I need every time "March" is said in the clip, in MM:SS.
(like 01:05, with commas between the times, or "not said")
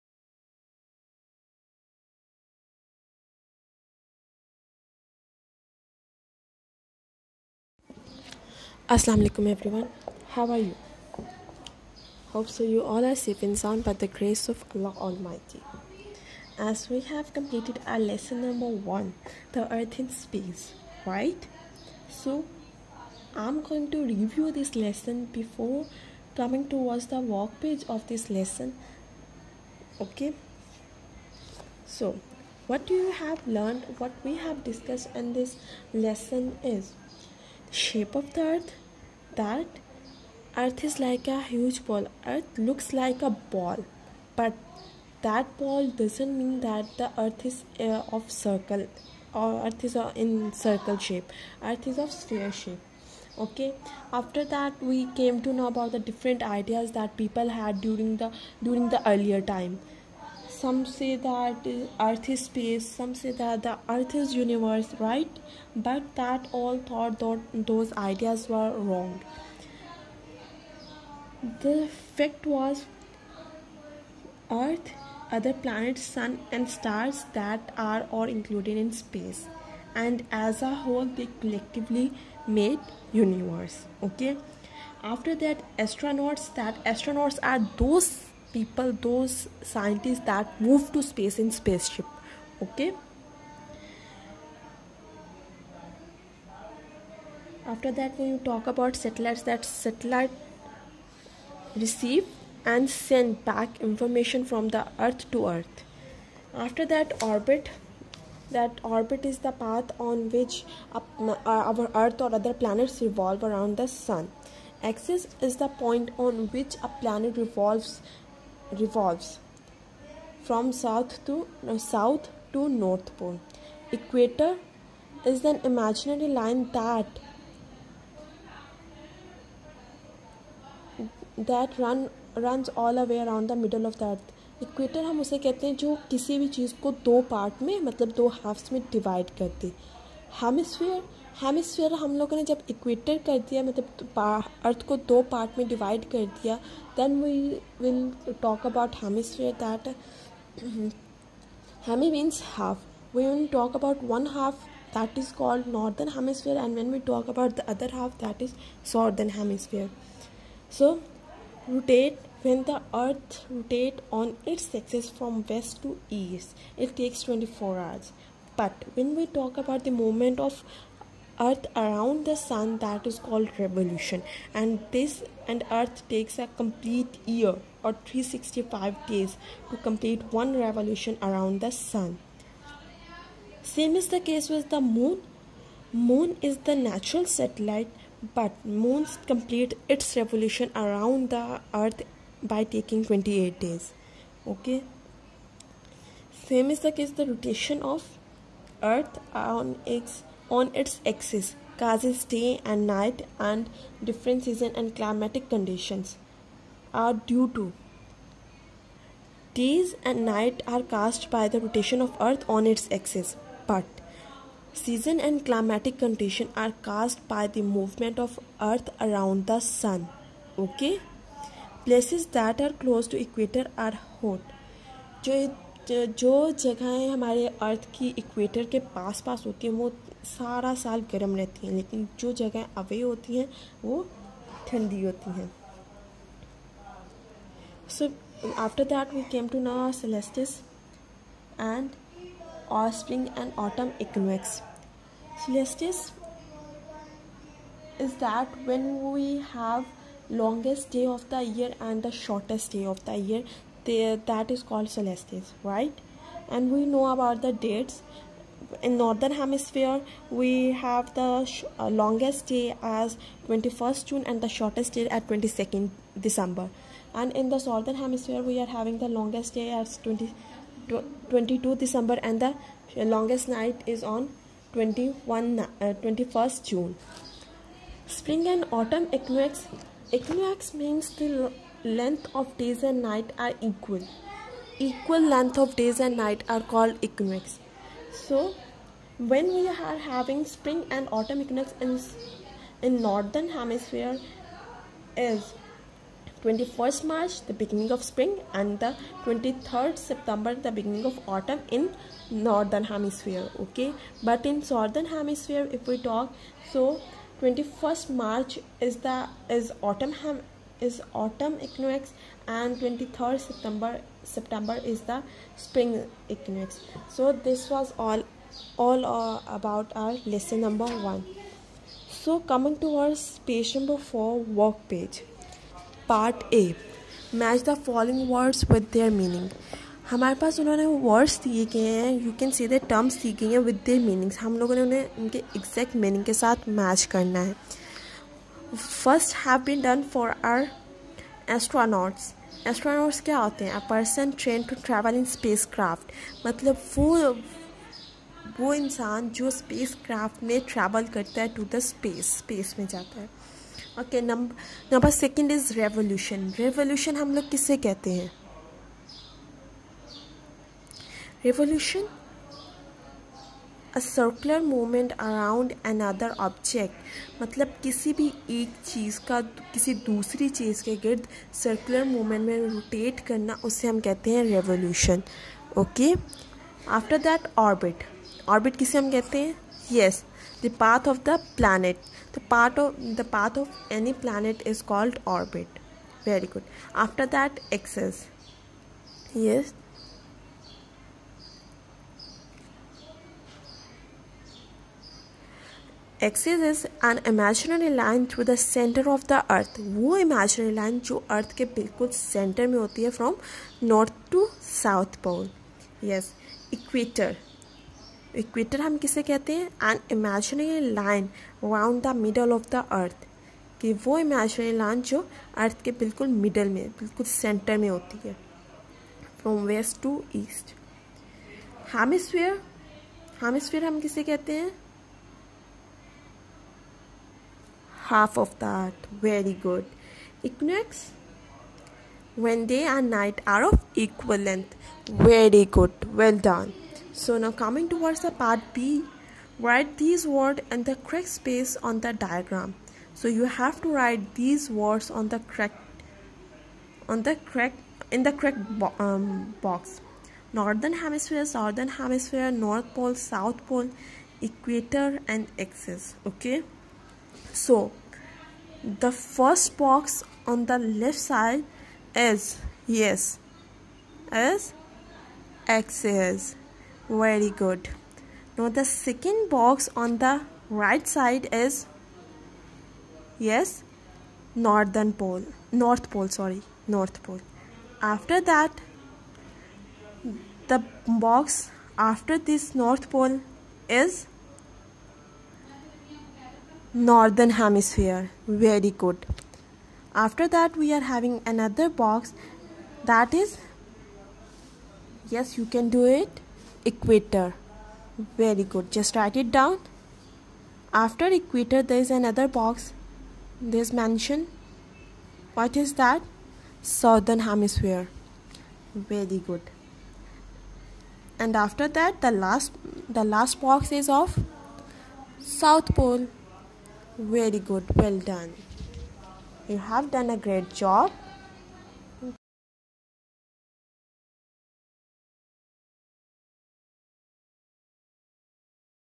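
04:57, 05:08.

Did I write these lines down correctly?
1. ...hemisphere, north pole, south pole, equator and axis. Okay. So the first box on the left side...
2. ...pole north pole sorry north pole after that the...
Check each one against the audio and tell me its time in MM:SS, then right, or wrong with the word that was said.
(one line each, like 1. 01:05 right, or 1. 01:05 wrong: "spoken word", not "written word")
1. 07:31 right
2. 07:55 right.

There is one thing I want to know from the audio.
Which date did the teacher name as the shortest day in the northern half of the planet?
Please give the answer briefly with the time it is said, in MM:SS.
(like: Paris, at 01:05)
22nd December, at 04:25.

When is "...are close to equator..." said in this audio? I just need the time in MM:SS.
03:42.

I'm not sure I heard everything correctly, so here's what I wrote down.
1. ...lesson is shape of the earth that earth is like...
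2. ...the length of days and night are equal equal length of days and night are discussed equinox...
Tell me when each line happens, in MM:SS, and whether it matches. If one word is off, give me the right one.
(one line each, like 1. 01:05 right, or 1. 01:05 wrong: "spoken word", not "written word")
1. 00:35 right
2. 04:41 wrong: "called", not "discussed".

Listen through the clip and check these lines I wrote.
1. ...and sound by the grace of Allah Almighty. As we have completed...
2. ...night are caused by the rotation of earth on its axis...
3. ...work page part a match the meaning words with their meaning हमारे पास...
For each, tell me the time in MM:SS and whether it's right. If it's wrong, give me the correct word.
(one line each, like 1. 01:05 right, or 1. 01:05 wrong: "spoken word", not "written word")
1. 00:13 right
2. 03:30 right
3. 05:24 wrong: "following", not "meaning".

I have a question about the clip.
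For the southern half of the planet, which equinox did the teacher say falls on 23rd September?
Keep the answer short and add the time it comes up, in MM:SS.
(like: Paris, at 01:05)
spring equinox, at 05:15.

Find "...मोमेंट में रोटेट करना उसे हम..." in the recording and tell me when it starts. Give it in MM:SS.
06:12.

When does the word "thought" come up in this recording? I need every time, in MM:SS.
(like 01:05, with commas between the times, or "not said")
01:06.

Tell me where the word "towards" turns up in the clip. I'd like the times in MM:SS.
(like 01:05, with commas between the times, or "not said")
00:26, 07:17.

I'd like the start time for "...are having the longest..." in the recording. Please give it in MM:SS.
04:28.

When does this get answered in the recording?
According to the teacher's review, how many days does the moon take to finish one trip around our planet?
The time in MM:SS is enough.
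03:13.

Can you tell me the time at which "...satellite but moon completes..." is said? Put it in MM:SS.
03:07.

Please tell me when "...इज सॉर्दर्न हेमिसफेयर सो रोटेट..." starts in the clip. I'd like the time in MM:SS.
02:38.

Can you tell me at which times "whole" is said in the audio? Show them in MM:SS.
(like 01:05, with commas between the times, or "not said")
01:20.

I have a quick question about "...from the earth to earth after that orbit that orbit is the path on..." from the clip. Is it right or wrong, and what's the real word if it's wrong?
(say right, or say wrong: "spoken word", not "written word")
right.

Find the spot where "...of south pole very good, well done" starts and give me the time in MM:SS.
08:34.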